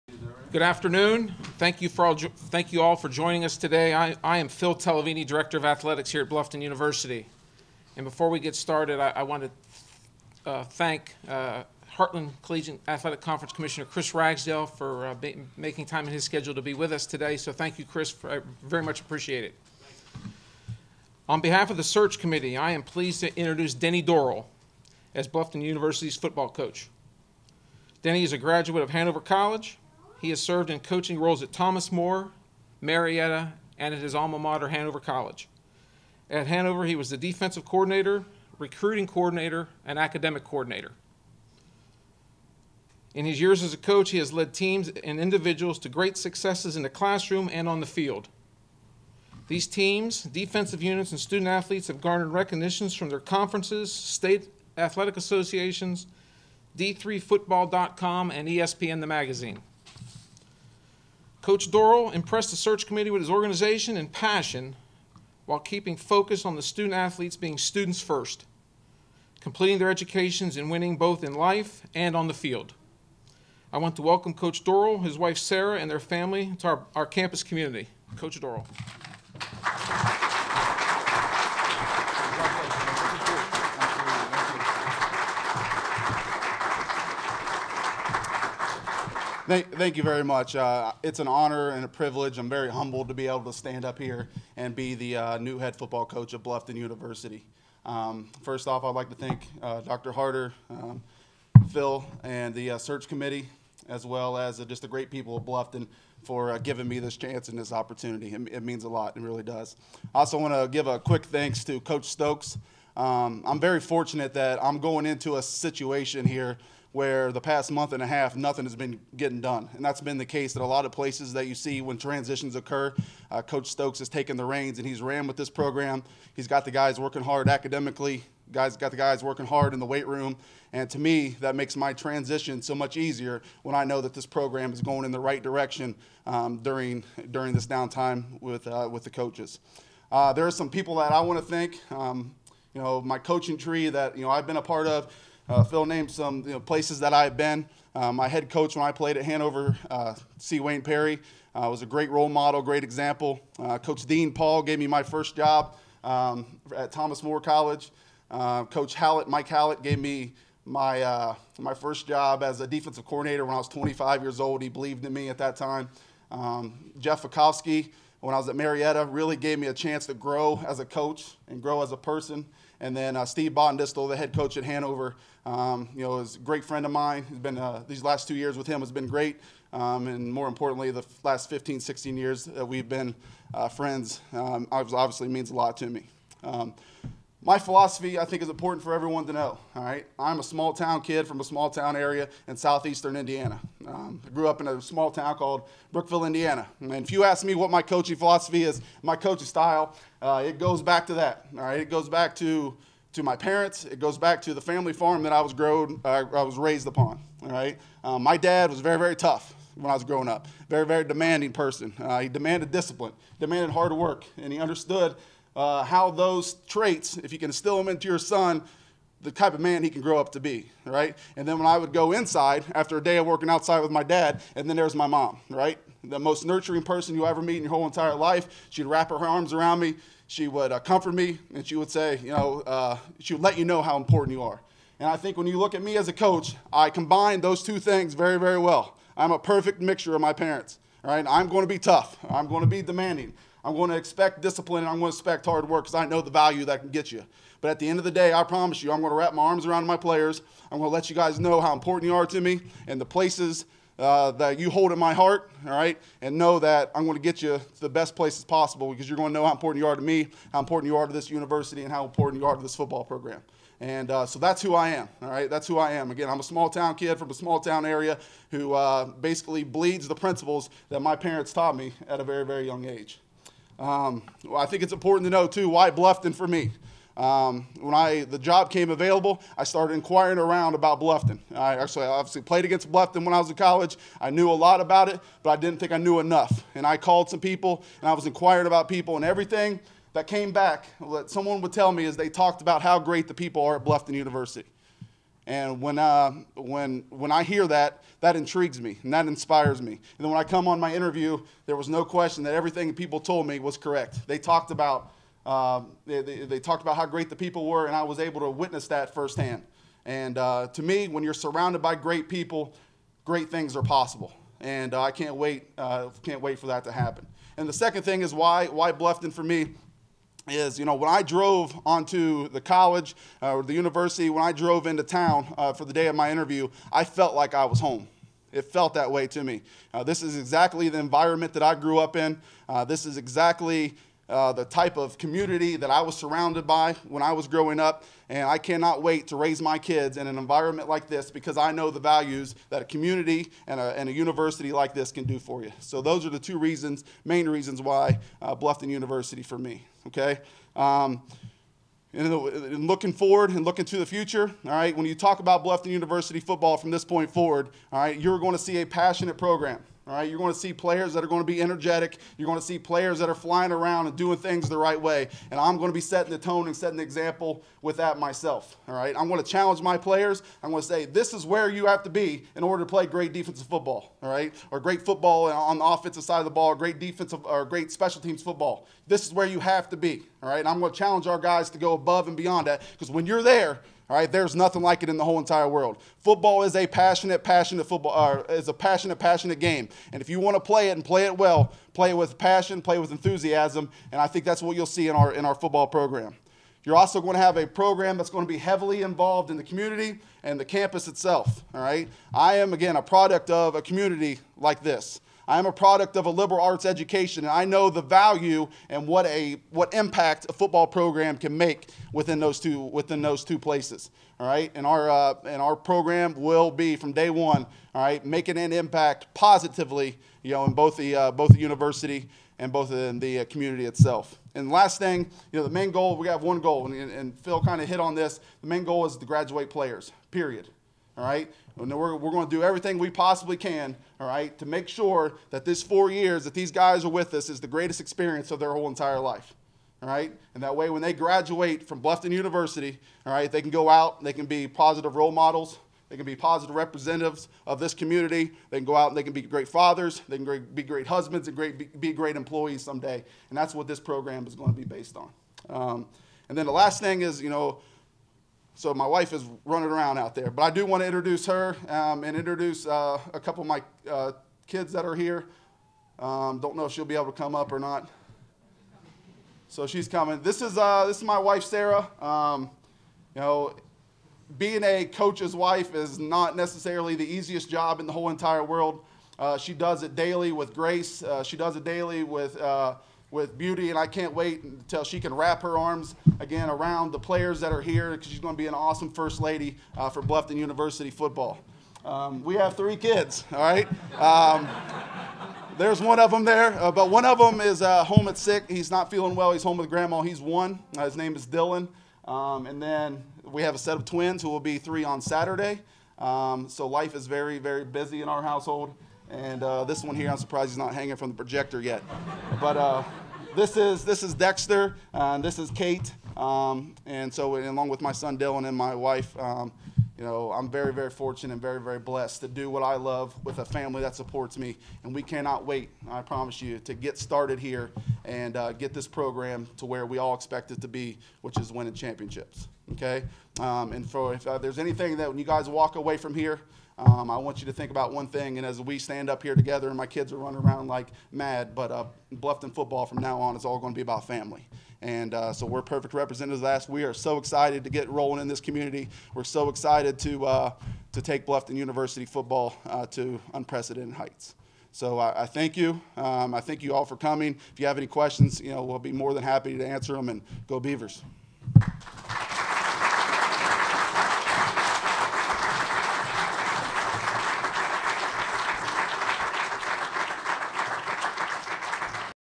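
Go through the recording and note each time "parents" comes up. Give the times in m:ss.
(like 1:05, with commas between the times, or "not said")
3:23, 4:00, 4:31.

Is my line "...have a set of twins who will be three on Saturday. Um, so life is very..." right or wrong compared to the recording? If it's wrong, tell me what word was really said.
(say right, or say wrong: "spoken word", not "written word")
right.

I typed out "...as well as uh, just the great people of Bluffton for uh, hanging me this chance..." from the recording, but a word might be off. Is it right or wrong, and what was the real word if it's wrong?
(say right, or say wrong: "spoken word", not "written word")
wrong: "giving", not "hanging".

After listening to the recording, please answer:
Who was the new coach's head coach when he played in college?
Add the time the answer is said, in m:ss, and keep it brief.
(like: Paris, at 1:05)
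C. Wayne Perry, at 2:30.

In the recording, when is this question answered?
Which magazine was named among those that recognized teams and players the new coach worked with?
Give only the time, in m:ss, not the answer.
0:58.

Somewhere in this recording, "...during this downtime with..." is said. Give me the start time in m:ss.
2:17.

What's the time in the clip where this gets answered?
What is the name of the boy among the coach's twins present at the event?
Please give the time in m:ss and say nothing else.
8:34.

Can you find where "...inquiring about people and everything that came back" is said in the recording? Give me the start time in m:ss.
4:48.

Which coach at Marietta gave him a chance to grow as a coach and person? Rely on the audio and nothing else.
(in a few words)
Jeff Fakowski.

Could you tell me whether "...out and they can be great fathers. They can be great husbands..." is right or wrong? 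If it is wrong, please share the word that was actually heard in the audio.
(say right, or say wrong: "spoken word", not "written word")
right.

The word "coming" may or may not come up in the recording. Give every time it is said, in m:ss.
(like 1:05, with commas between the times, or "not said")
7:50, 9:17.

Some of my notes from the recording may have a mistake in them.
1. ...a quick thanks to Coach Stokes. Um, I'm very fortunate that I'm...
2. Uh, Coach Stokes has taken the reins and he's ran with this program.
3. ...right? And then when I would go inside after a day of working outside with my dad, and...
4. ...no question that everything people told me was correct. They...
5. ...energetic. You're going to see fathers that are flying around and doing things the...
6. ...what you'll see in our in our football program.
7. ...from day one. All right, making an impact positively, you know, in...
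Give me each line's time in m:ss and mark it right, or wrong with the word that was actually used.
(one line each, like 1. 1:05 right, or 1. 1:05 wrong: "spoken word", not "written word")
1. 1:50 right
2. 2:03 right
3. 3:40 right
4. 5:01 right
5. 6:01 wrong: "players", not "fathers"
6. 6:34 right
7. 6:56 right.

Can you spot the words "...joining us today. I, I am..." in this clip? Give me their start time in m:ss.
0:03.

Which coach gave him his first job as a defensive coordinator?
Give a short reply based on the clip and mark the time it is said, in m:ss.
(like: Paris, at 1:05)
Mike Hallett, at 2:39.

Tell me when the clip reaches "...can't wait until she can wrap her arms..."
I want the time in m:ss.
8:04.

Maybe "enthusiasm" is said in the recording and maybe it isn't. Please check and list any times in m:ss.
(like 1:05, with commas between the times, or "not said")
6:33.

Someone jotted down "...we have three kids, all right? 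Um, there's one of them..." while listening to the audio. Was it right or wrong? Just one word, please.
right.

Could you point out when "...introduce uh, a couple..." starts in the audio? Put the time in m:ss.
7:42.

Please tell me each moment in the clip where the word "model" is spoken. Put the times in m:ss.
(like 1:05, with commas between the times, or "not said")
2:32, 7:25.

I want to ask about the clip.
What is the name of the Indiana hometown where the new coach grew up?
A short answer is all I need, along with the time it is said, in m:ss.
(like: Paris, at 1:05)
Brookville, at 3:15.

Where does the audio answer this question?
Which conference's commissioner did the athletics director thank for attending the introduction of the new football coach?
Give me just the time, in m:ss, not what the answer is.
0:11.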